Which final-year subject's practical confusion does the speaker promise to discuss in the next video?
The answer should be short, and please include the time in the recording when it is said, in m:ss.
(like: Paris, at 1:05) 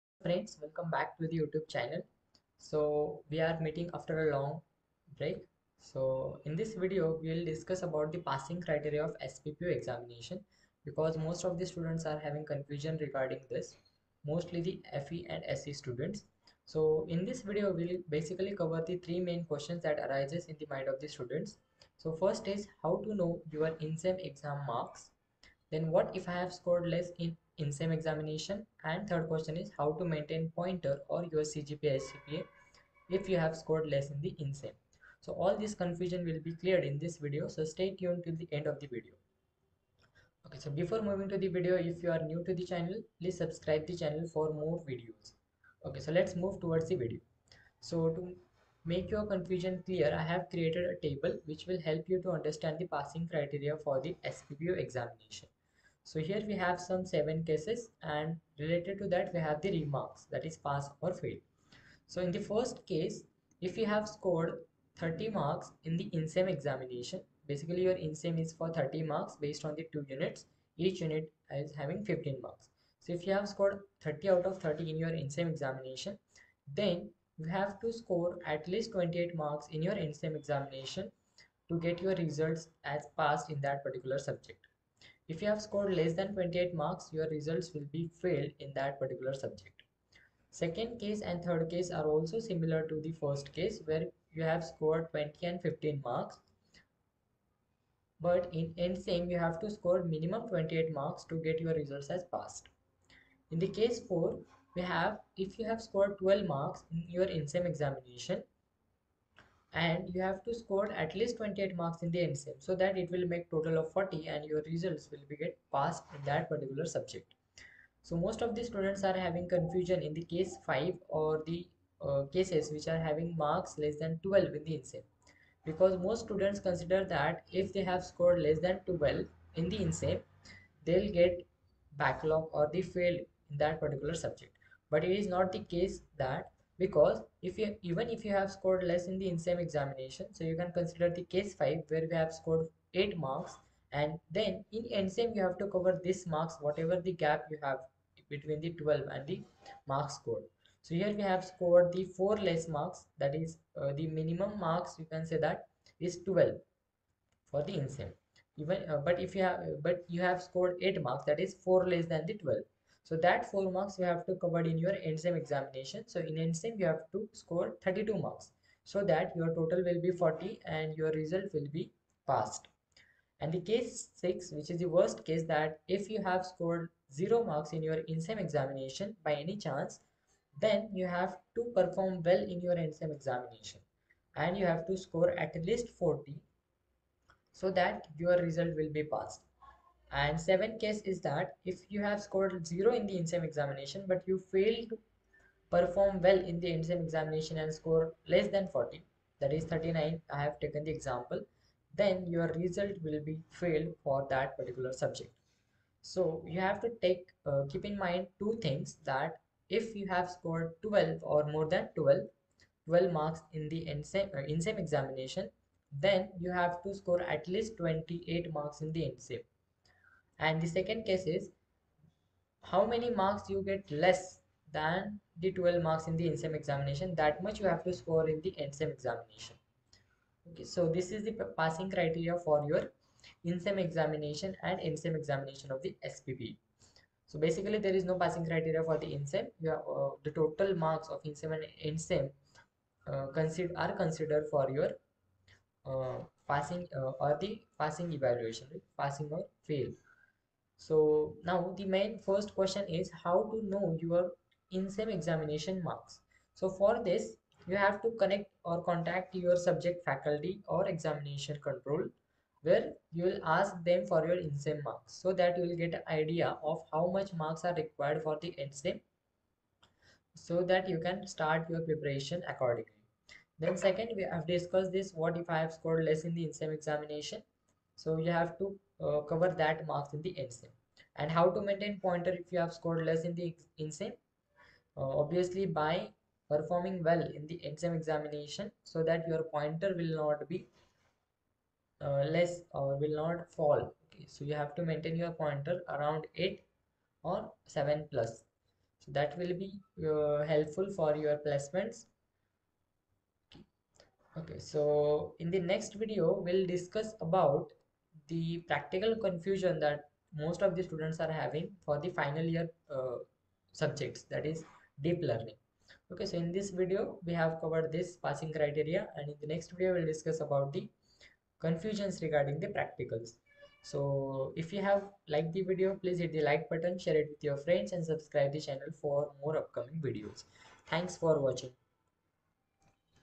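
Deep learning, at 5:15.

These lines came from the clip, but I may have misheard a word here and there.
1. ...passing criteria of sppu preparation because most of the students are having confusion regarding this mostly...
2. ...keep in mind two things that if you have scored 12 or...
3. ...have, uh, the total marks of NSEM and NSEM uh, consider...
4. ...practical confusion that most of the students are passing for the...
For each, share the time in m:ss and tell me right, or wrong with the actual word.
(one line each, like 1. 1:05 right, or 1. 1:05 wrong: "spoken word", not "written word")
1. 0:08 wrong: "examination", not "preparation"
2. 3:27 right
3. 3:59 right
4. 5:08 wrong: "having", not "passing".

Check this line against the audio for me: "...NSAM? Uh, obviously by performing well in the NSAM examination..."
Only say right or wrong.
right.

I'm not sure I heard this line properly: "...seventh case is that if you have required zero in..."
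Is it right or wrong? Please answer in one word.
wrong.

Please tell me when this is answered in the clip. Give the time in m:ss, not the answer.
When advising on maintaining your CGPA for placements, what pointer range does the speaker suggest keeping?
4:56.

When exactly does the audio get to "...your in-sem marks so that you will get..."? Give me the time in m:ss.
4:24.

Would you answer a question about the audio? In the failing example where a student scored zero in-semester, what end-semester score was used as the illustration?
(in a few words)
39.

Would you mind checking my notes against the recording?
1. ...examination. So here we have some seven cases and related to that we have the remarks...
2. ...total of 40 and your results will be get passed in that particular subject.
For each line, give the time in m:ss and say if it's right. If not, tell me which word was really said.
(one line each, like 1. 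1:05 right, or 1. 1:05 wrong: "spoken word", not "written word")
1. 0:54 right
2. 1:53 right.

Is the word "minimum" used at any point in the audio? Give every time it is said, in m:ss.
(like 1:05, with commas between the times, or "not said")
1:40, 2:34.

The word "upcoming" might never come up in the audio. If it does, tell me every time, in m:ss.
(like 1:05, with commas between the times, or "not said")
5:29.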